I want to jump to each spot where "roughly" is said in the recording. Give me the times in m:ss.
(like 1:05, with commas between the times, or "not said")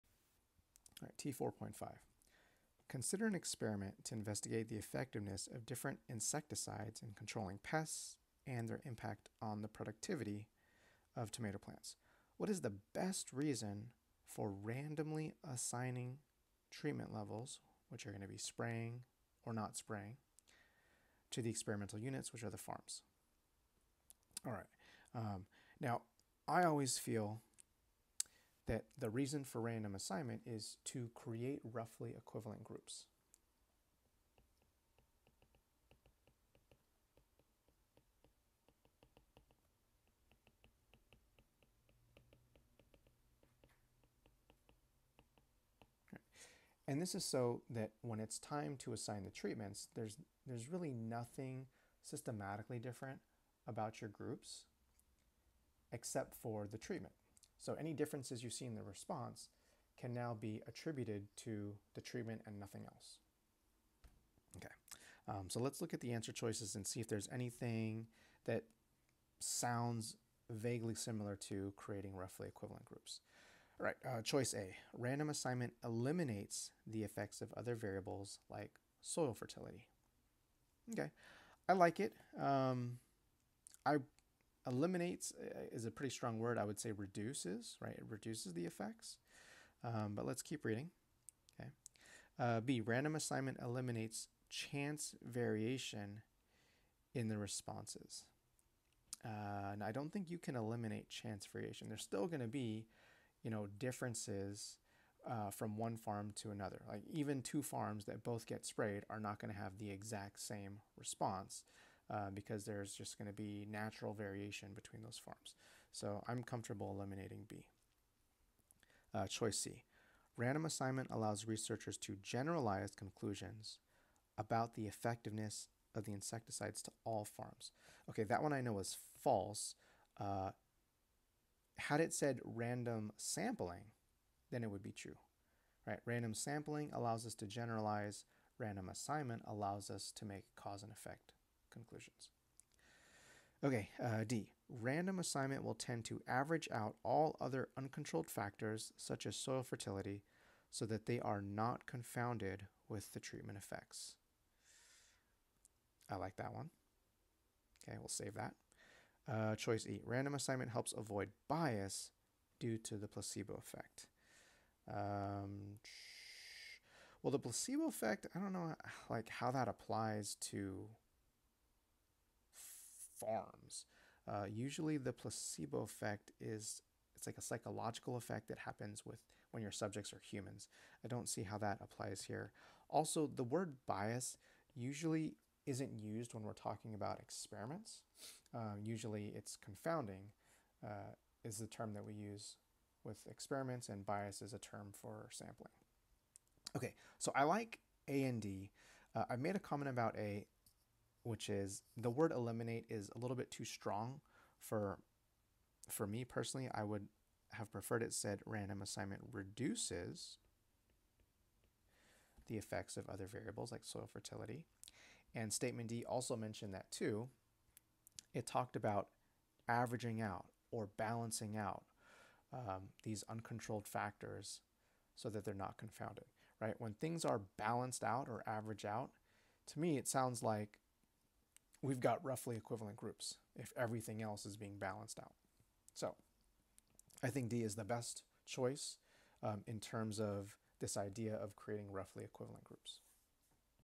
0:31, 1:12, 3:52, 4:01.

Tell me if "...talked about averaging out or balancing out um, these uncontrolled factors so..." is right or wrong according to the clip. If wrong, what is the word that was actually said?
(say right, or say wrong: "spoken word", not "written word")
right.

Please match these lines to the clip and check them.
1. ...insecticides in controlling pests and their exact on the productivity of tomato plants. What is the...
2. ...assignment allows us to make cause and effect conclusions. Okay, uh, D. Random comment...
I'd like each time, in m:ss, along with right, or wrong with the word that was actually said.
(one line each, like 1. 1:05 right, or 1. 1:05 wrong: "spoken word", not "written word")
1. 0:06 wrong: "impact", not "exact"
2. 2:18 wrong: "assignment", not "comment".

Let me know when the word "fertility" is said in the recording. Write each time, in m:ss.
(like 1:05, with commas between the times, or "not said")
1:19, 2:29, 3:34.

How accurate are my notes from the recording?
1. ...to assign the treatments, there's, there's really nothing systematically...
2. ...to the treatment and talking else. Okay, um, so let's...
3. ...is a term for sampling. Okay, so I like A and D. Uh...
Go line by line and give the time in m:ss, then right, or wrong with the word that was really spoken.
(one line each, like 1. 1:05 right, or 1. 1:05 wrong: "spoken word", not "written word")
1. 0:48 right
2. 1:01 wrong: "nothing", not "talking"
3. 3:14 right.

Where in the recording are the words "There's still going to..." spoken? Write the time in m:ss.
1:41.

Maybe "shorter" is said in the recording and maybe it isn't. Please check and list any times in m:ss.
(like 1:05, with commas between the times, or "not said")
not said.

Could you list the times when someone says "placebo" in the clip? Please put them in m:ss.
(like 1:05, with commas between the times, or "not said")
2:43, 2:47, 2:55.